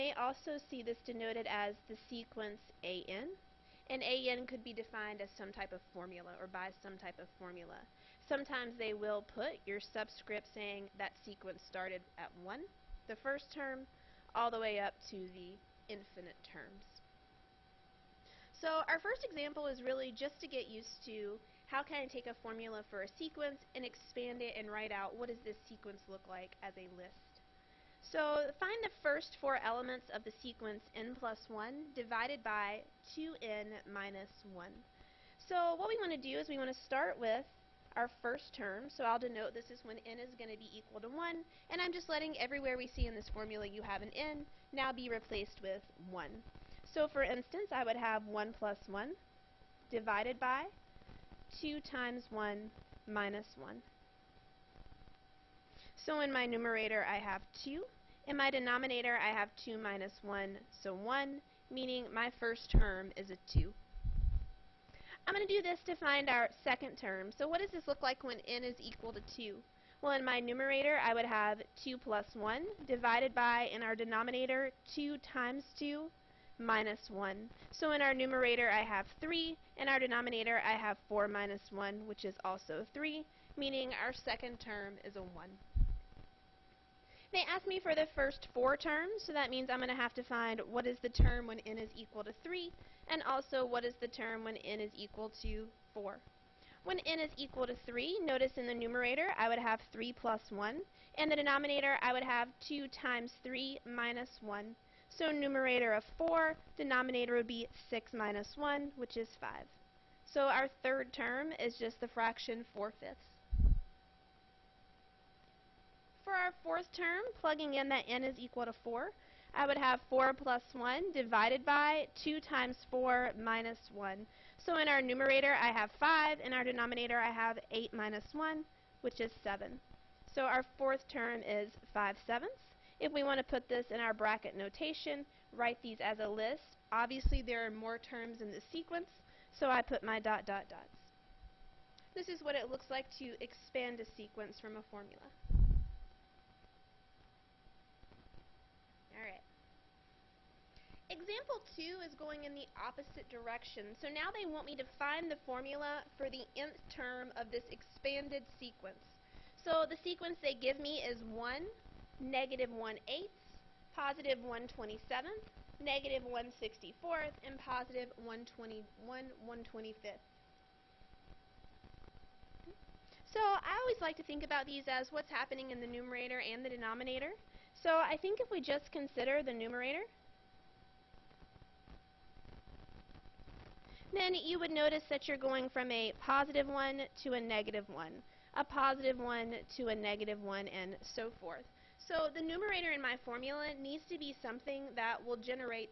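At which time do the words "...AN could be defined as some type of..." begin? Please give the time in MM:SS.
00:04.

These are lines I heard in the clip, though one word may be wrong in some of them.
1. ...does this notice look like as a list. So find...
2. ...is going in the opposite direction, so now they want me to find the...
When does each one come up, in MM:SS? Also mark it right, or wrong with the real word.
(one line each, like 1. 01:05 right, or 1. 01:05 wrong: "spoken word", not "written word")
1. 00:25 wrong: "sequence", not "notice"
2. 02:32 right.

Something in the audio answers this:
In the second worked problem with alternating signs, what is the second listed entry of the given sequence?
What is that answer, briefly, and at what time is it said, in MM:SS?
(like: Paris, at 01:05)
-1/8, at 02:42.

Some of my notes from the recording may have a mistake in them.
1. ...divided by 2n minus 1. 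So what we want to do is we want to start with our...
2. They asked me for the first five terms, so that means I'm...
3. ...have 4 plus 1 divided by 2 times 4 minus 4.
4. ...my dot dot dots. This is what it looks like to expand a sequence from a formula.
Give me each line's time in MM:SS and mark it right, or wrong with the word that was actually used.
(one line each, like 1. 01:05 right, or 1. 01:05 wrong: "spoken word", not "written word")
1. 00:31 right
2. 01:27 wrong: "four", not "five"
3. 01:59 wrong: "1", not "4"
4. 02:20 right.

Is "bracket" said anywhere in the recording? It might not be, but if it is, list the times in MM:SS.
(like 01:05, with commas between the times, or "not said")
02:14.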